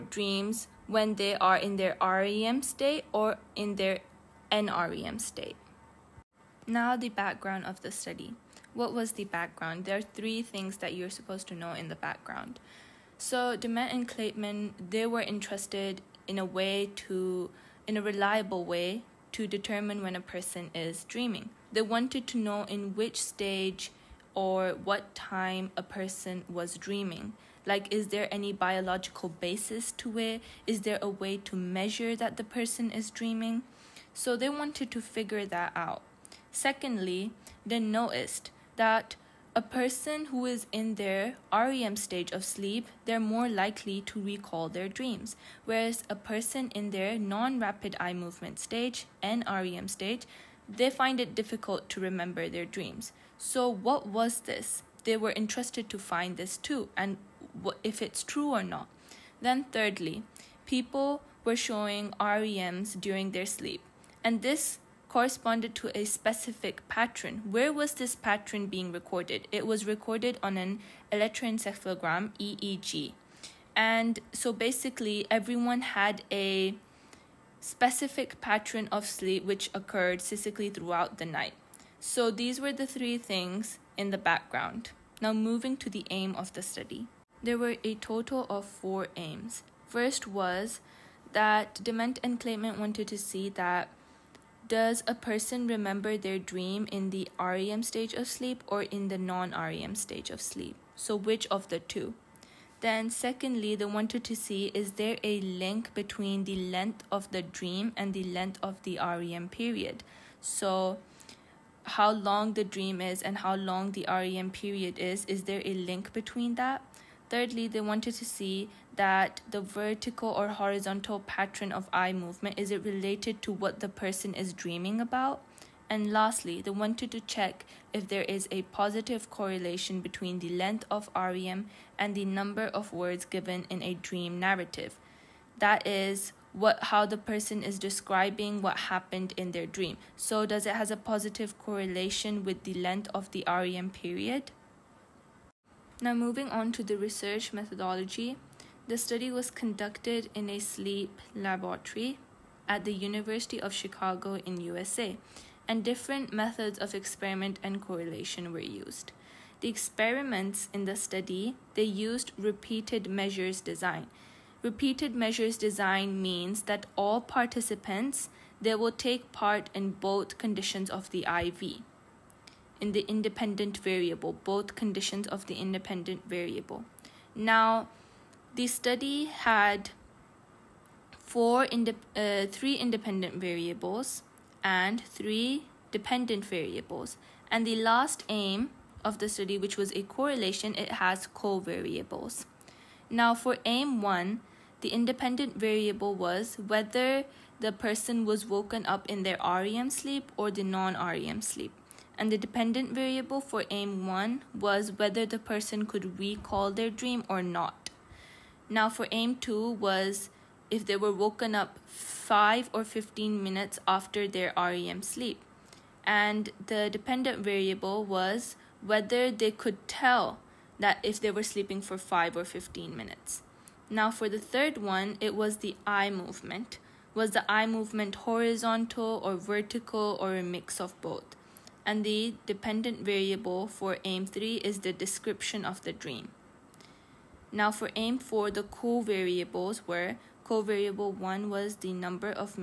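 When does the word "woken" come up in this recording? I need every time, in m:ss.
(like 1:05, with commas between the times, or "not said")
3:18, 3:31.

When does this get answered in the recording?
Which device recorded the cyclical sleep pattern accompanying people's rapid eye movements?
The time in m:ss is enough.
1:11.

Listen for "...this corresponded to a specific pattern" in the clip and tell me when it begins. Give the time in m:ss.
1:04.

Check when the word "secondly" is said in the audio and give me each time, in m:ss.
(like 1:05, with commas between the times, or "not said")
0:36, 1:43.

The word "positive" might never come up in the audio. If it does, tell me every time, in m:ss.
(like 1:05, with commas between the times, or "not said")
2:08, 2:20.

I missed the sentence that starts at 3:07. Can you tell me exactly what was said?
And the last aim of the study, which was a correlation, it has covariables.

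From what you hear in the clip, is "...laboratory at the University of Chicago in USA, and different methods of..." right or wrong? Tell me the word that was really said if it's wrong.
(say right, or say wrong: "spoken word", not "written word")
right.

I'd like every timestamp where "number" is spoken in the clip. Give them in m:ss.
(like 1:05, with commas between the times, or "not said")
2:12, 4:01.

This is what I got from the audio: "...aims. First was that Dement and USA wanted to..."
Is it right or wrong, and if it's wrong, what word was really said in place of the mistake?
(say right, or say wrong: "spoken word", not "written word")
wrong: "Kleitman", not "USA".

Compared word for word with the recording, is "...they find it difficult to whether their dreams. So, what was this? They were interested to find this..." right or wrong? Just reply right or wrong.
wrong.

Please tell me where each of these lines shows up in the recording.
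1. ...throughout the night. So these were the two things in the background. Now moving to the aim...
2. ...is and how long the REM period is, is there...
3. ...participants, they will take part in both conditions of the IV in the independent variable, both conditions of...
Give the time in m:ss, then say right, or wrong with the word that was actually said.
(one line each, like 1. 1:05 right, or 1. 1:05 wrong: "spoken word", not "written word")
1. 1:20 wrong: "three", not "two"
2. 1:53 right
3. 2:47 right.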